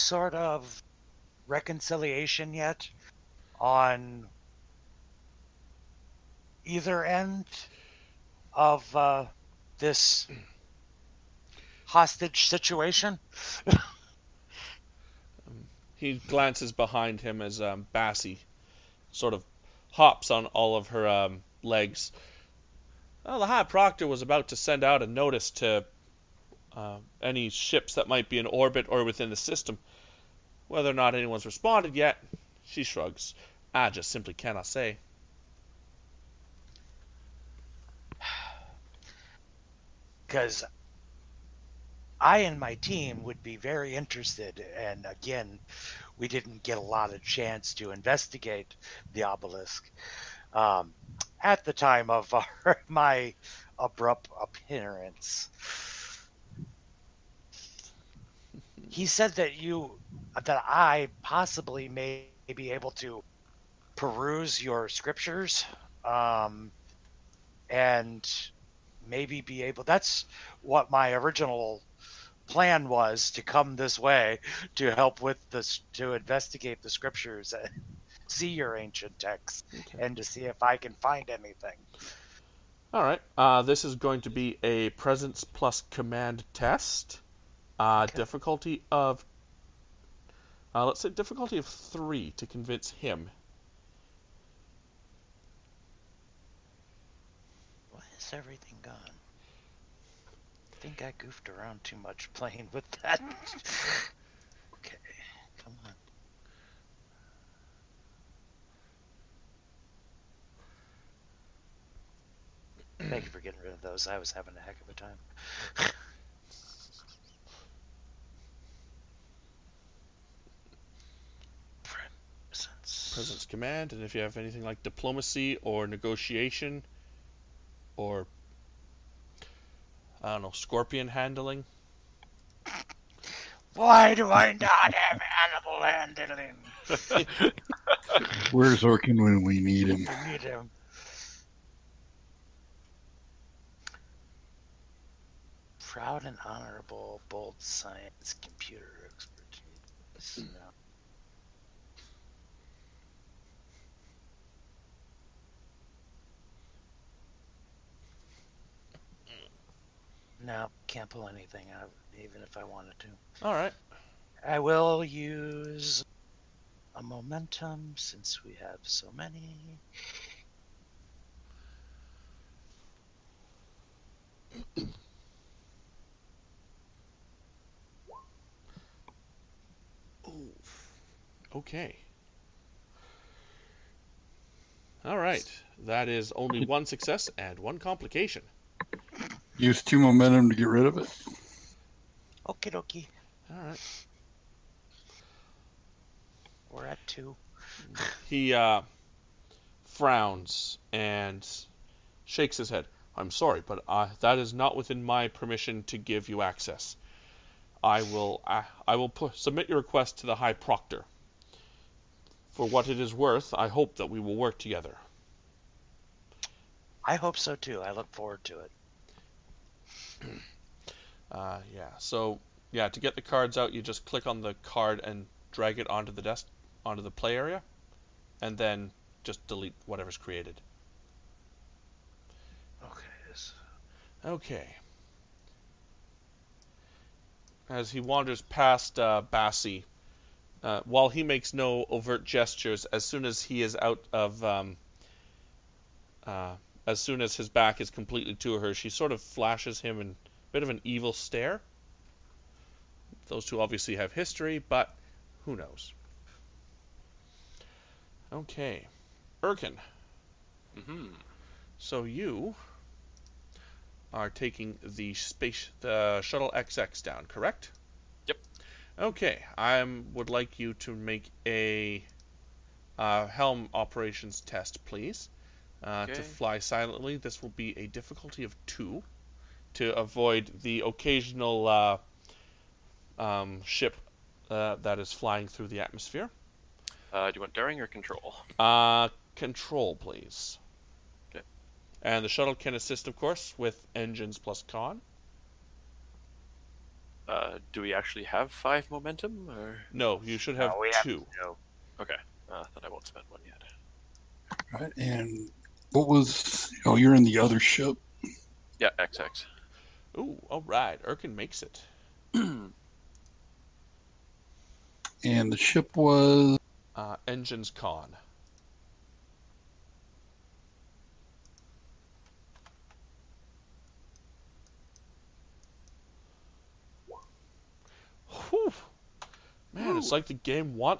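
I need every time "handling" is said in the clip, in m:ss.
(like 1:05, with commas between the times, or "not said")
2:11, 2:15.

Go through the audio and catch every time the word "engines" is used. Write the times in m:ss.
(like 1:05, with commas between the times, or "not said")
4:53, 5:17.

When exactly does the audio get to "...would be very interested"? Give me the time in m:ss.
0:43.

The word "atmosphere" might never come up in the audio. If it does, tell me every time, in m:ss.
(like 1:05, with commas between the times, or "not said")
4:45.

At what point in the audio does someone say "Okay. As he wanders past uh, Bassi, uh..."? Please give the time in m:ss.
3:54.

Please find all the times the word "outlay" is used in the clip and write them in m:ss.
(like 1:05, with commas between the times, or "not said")
not said.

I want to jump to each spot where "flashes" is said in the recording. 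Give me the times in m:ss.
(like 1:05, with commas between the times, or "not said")
4:09.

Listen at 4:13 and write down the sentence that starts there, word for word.
Those two obviously have history, but who knows?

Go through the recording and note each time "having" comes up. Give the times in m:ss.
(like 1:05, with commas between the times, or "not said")
1:54.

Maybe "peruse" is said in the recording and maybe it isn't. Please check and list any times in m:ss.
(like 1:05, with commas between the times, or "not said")
1:03.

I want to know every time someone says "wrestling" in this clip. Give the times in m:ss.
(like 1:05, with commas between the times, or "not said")
not said.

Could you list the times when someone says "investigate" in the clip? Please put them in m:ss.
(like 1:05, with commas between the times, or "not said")
0:47, 1:16.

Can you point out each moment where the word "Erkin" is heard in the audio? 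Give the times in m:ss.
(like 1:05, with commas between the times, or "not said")
4:19, 5:11.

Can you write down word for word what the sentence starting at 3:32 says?
For what it is worth, I hope that we will work together.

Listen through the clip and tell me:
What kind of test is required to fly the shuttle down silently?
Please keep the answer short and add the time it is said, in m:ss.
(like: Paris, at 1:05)
Helm operations, at 4:33.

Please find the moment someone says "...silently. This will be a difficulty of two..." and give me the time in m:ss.
4:36.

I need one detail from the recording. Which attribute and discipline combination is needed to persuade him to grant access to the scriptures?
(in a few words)
Presence plus command.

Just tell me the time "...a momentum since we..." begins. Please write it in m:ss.
2:46.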